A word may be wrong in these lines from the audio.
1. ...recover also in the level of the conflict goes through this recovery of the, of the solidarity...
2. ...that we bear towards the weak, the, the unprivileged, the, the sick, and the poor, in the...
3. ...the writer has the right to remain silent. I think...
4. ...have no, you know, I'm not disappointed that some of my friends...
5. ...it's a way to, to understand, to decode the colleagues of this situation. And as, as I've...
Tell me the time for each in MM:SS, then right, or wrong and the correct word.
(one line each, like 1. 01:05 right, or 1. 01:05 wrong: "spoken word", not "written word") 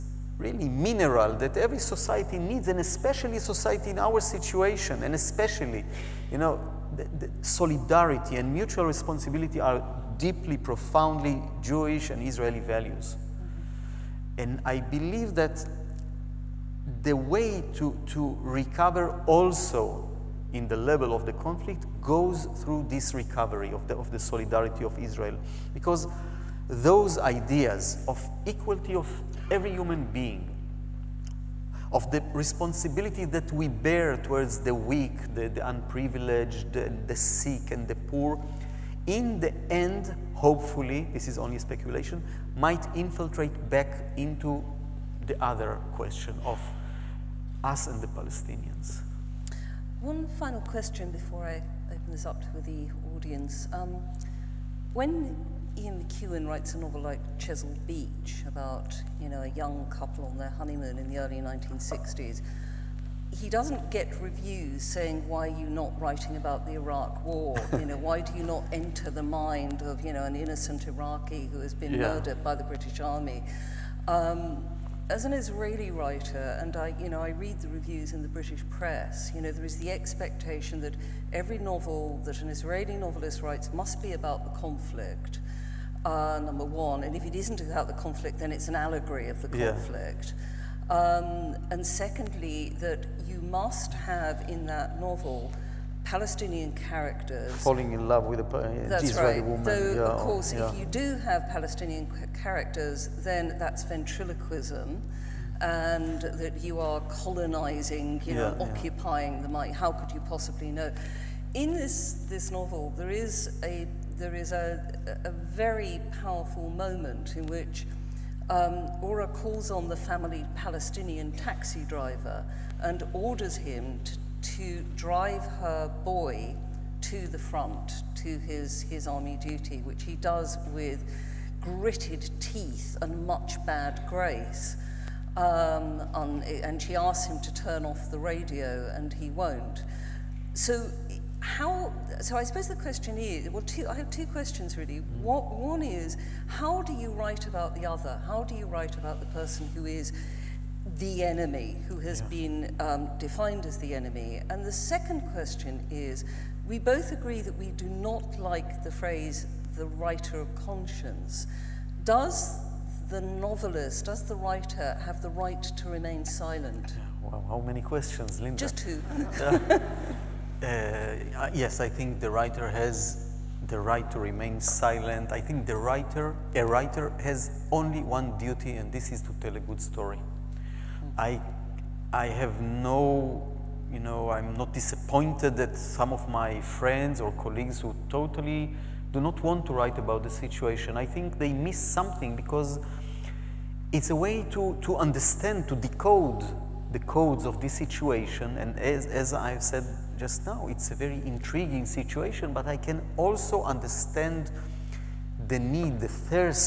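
1. 00:18 right
2. 00:33 right
3. 02:52 right
4. 03:02 right
5. 03:13 wrong: "codes", not "colleagues".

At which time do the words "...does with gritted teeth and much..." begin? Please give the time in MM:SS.
02:10.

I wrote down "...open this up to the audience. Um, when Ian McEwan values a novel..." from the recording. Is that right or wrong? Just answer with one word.
wrong.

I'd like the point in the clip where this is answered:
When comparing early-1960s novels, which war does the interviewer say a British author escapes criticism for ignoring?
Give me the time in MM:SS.
01:06.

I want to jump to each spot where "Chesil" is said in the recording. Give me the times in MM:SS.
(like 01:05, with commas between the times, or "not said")
00:57.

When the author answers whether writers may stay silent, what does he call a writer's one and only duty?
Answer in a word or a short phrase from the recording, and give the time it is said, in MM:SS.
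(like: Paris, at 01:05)
to tell a good story, at 02:59.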